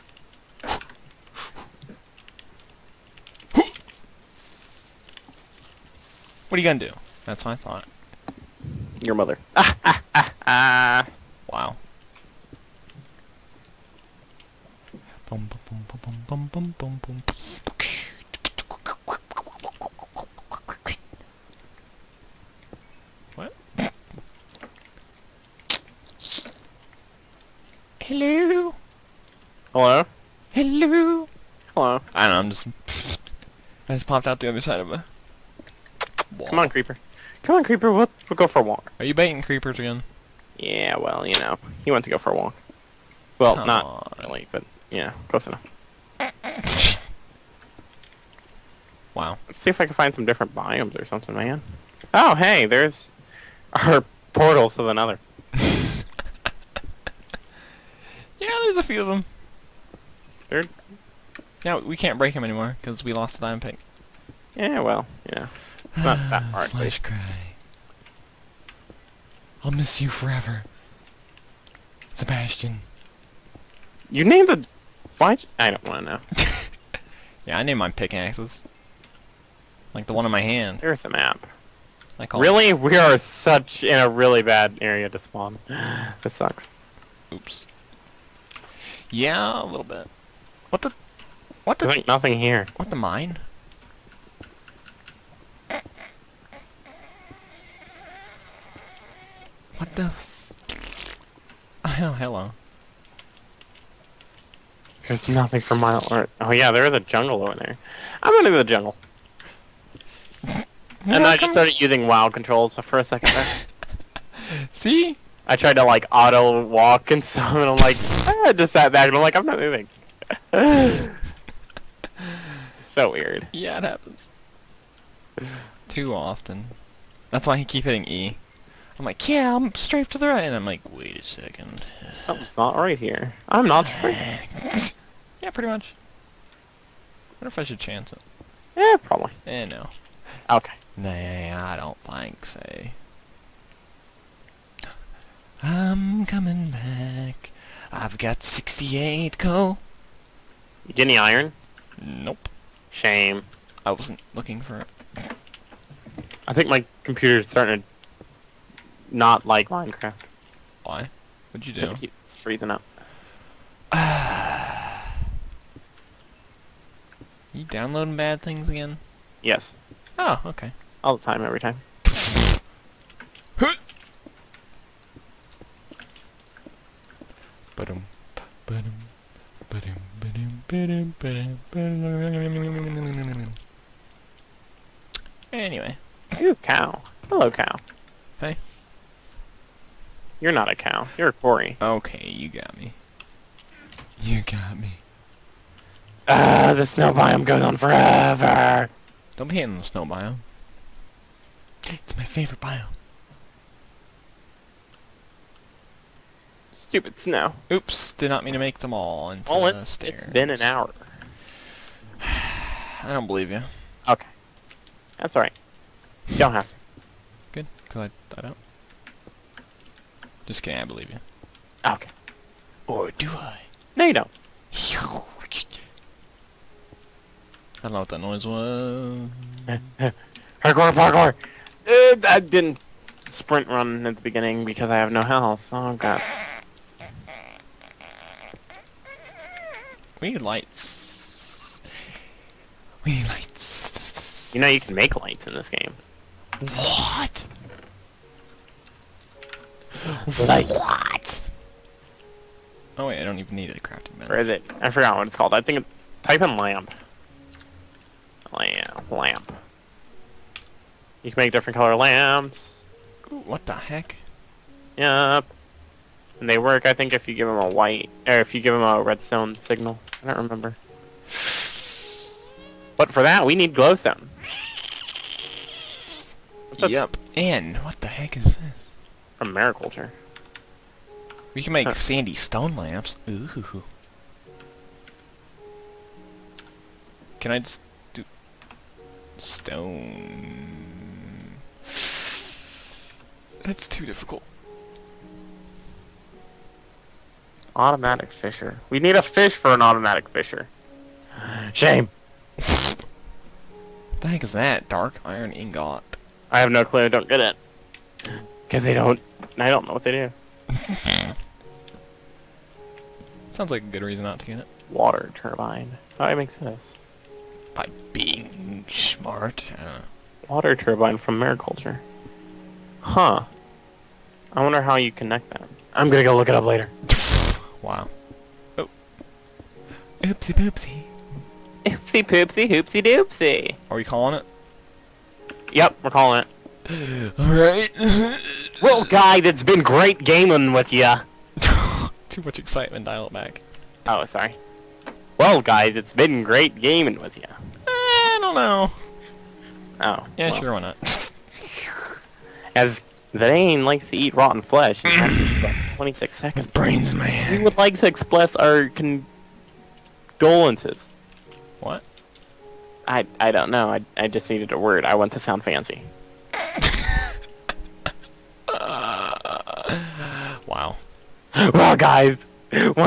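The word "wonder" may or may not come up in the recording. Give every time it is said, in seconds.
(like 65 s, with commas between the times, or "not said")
137 s, 324 s.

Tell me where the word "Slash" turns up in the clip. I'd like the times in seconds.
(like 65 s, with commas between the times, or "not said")
66 s.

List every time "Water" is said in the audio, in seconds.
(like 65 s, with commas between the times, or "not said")
314 s, 320 s.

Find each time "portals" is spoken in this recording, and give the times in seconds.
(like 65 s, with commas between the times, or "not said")
54 s.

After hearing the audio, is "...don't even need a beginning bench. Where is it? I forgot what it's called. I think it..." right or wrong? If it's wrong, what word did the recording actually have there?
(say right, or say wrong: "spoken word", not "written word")
wrong: "crafting", not "beginning".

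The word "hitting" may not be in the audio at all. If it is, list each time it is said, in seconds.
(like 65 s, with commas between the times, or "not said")
127 s, 199 s.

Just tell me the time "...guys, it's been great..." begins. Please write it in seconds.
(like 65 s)
345 s.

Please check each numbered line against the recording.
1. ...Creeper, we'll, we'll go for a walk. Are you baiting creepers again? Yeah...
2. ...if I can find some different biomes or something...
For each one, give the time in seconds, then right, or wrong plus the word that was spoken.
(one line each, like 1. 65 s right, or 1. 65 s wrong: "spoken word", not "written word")
1. 37 s right
2. 49 s right.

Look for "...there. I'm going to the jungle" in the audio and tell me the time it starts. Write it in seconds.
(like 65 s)
107 s.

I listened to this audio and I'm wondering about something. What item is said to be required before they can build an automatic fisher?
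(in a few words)
a fish.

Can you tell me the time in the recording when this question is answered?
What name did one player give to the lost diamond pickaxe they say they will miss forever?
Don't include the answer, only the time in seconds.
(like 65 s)
72 s.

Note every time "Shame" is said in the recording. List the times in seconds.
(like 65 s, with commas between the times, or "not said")
152 s, 301 s.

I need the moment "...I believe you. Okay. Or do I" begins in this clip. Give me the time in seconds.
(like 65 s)
220 s.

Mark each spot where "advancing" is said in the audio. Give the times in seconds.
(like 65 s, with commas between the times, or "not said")
not said.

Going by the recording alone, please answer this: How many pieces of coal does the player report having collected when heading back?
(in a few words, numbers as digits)
68.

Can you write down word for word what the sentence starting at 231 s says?
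Uh, I didn't sprint run at the beginning because I have no health.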